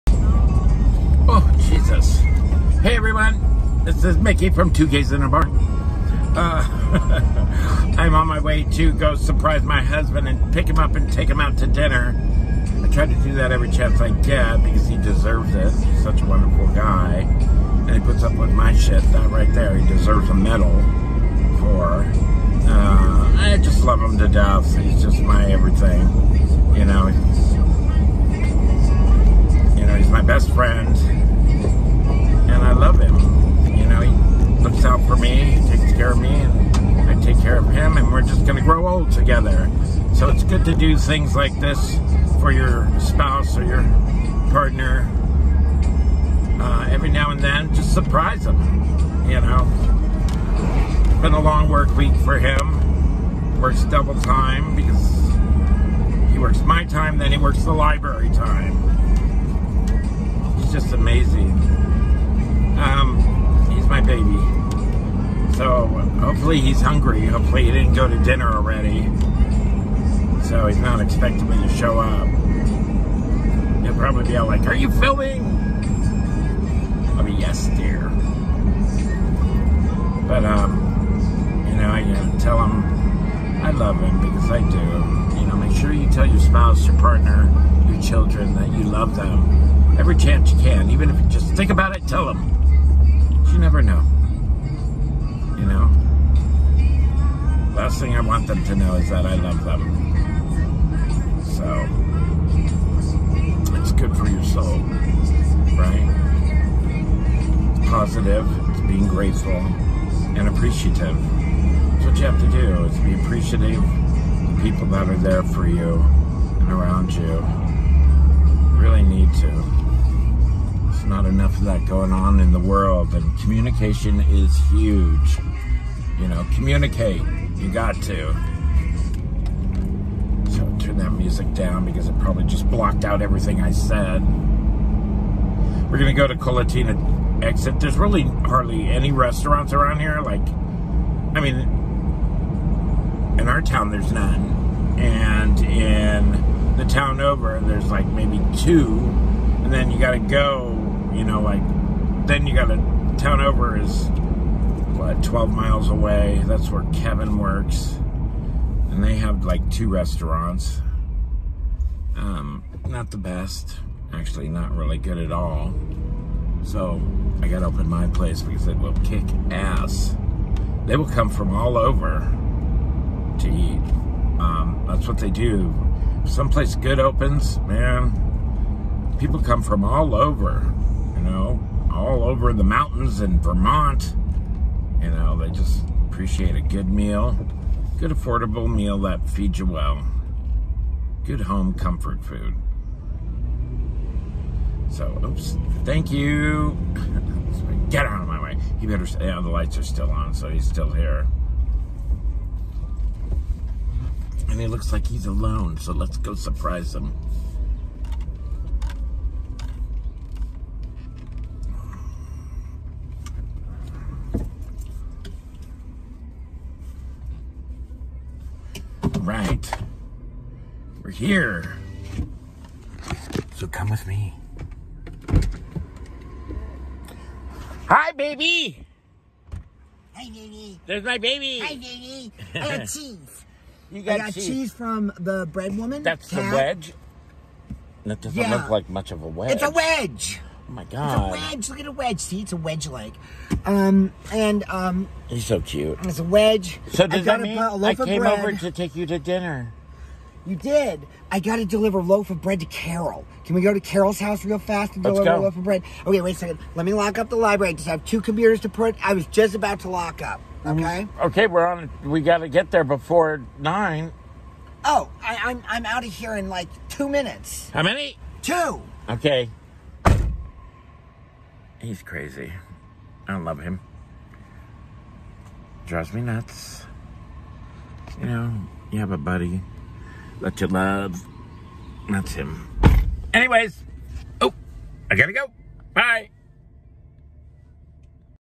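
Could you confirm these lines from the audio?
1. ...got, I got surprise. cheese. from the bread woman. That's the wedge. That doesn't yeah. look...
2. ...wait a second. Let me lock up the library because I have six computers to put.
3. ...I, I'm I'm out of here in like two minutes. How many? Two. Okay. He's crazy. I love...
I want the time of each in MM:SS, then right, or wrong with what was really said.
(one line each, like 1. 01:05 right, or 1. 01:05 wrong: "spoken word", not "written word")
1. 03:54 wrong: "cheese", not "surprise"
2. 04:16 wrong: "two", not "six"
3. 04:25 right.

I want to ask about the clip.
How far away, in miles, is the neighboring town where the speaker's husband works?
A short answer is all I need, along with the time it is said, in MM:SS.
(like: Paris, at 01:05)
12, at 02:35.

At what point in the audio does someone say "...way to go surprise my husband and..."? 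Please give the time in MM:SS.
00:08.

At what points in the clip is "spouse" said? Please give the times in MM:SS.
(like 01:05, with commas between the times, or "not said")
00:42, 01:26.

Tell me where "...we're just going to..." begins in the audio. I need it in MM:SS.
00:38.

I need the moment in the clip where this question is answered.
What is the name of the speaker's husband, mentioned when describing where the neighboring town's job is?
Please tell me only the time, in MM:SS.
02:36.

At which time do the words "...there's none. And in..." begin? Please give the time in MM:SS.
02:23.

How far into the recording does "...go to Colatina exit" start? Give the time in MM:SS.
02:16.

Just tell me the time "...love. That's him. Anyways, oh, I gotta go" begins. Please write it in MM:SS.
04:40.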